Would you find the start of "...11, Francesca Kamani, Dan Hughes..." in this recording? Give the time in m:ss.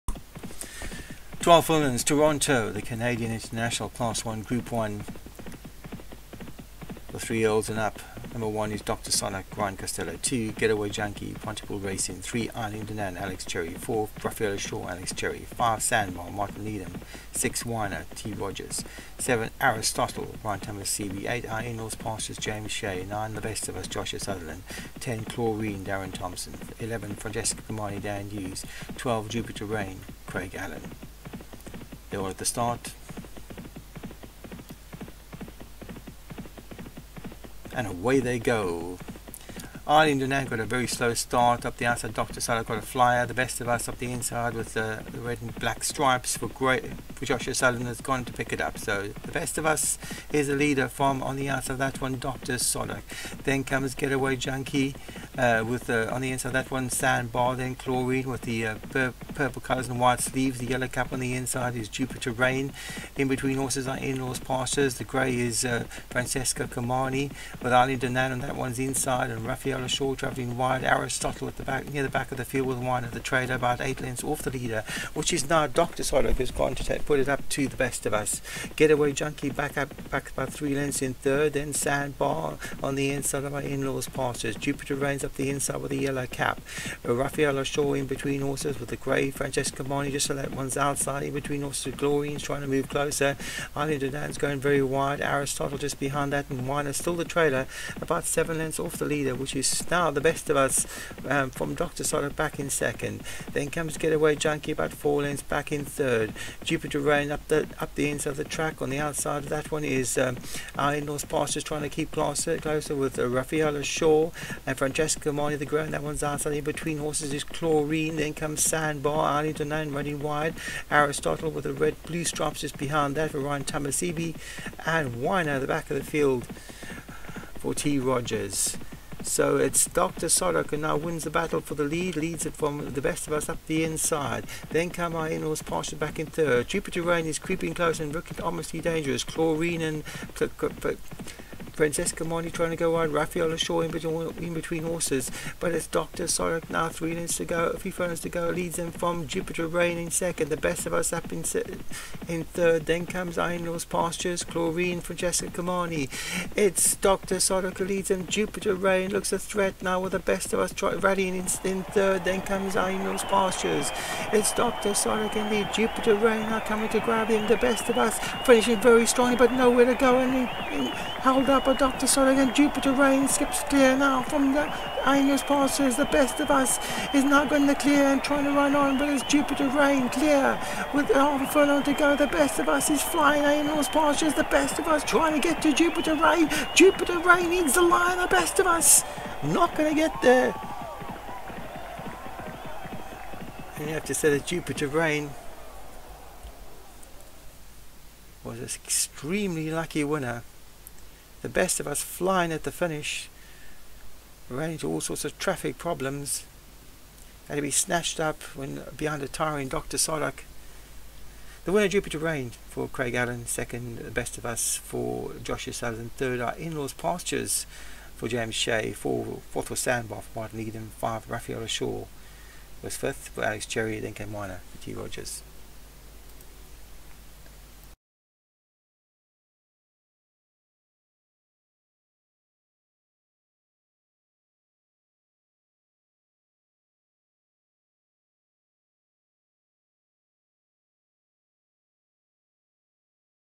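0:26.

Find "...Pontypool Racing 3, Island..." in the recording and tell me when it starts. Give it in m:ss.
0:11.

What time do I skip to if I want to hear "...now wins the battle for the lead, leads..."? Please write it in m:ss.
2:10.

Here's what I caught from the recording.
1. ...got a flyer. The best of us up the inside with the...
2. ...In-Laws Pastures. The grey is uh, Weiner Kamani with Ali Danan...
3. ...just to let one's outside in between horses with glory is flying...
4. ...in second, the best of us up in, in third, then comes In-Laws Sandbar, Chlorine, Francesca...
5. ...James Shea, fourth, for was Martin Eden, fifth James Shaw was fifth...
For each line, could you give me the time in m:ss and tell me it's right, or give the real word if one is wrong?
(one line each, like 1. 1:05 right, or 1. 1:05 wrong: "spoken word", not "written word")
1. 0:42 right
2. 1:03 wrong: "Francesca", not "Weiner"
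3. 1:30 wrong: "trying", not "flying"
4. 2:29 wrong: "Pastures", not "Sandbar"
5. 3:38 wrong: "Raphael", not "James".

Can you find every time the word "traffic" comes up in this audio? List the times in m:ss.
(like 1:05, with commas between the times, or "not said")
3:25.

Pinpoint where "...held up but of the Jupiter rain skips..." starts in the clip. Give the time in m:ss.
2:51.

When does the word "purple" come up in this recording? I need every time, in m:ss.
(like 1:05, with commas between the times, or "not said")
0:59.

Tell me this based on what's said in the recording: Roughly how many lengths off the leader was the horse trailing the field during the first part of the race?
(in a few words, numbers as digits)
8.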